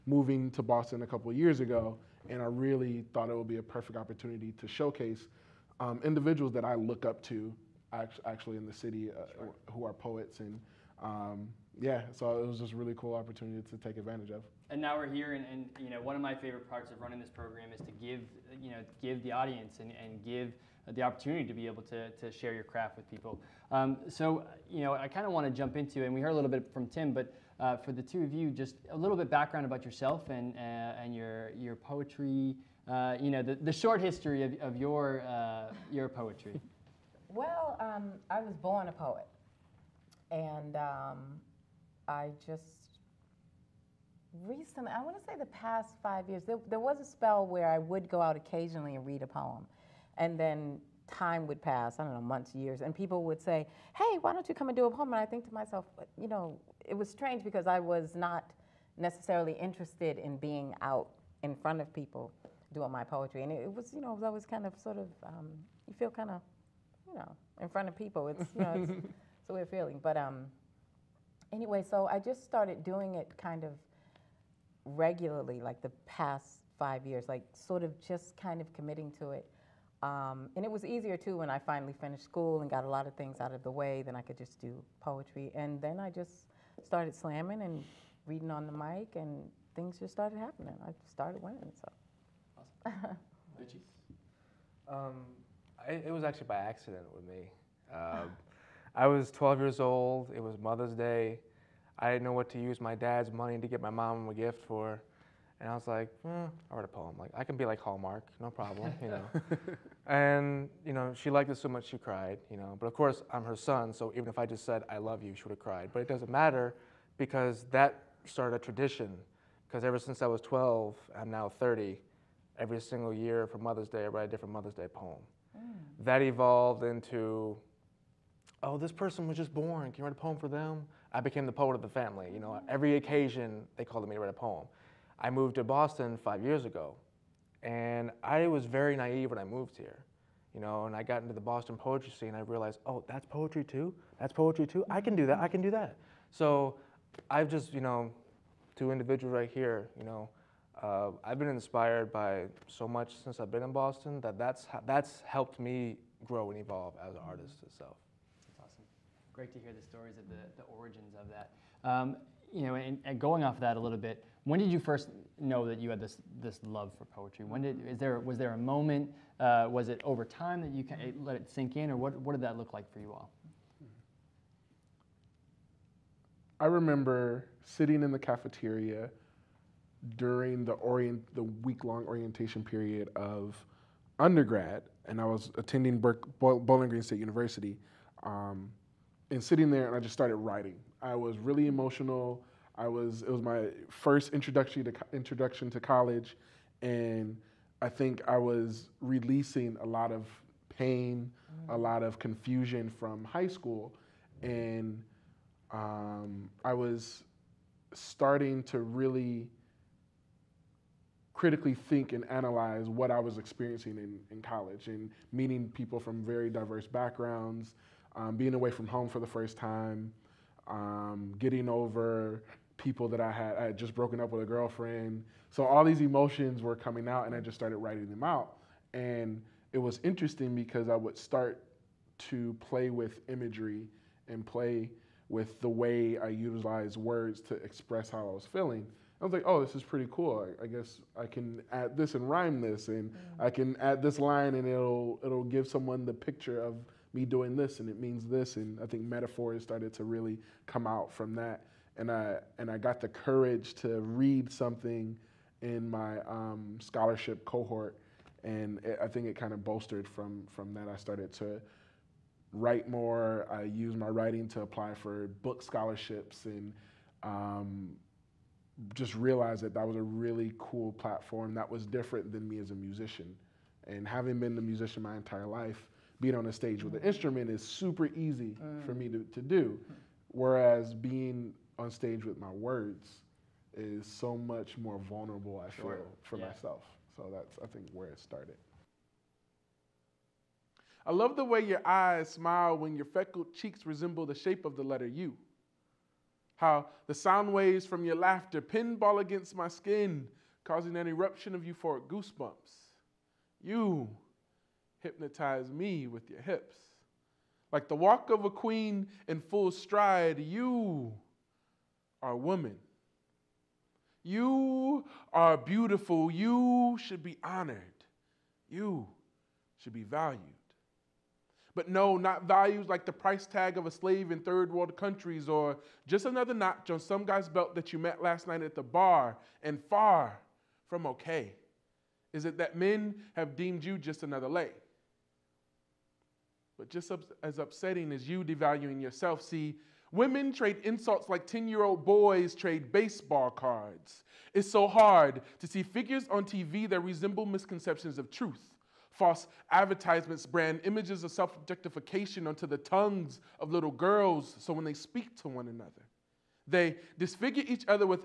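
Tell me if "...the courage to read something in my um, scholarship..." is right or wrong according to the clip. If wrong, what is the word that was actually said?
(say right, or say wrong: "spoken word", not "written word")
right.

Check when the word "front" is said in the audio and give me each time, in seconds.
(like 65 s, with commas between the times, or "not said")
61 s, 67 s.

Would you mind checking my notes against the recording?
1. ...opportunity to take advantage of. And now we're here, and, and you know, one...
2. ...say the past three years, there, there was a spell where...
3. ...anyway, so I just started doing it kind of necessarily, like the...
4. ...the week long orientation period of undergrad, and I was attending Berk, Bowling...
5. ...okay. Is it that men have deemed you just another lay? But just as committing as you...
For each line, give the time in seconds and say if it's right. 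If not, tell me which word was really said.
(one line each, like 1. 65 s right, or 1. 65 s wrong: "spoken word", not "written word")
1. 13 s right
2. 45 s wrong: "five", not "three"
3. 71 s wrong: "regularly", not "necessarily"
4. 181 s right
5. 331 s wrong: "upsetting", not "committing".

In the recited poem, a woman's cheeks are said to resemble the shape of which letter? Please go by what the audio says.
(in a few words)
U.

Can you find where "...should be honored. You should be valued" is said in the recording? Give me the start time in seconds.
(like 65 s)
317 s.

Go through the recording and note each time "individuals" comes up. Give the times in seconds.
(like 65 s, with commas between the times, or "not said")
6 s, 148 s.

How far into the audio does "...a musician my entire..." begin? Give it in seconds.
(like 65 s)
274 s.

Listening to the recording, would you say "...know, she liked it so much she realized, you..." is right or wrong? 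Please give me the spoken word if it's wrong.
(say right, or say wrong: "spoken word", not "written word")
wrong: "cried", not "realized".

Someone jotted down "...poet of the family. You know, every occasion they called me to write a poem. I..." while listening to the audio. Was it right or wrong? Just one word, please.
right.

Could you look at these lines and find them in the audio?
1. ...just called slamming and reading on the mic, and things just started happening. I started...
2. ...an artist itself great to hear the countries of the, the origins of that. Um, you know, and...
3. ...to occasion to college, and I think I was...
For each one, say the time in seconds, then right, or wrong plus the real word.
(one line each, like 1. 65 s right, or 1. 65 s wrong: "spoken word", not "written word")
1. 86 s wrong: "started", not "called"
2. 157 s wrong: "stories", not "countries"
3. 194 s wrong: "introduction", not "occasion".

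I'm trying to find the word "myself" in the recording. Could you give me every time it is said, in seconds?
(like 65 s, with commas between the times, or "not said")
55 s, 286 s.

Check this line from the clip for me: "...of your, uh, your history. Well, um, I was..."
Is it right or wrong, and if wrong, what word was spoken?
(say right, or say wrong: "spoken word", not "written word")
wrong: "poetry", not "history".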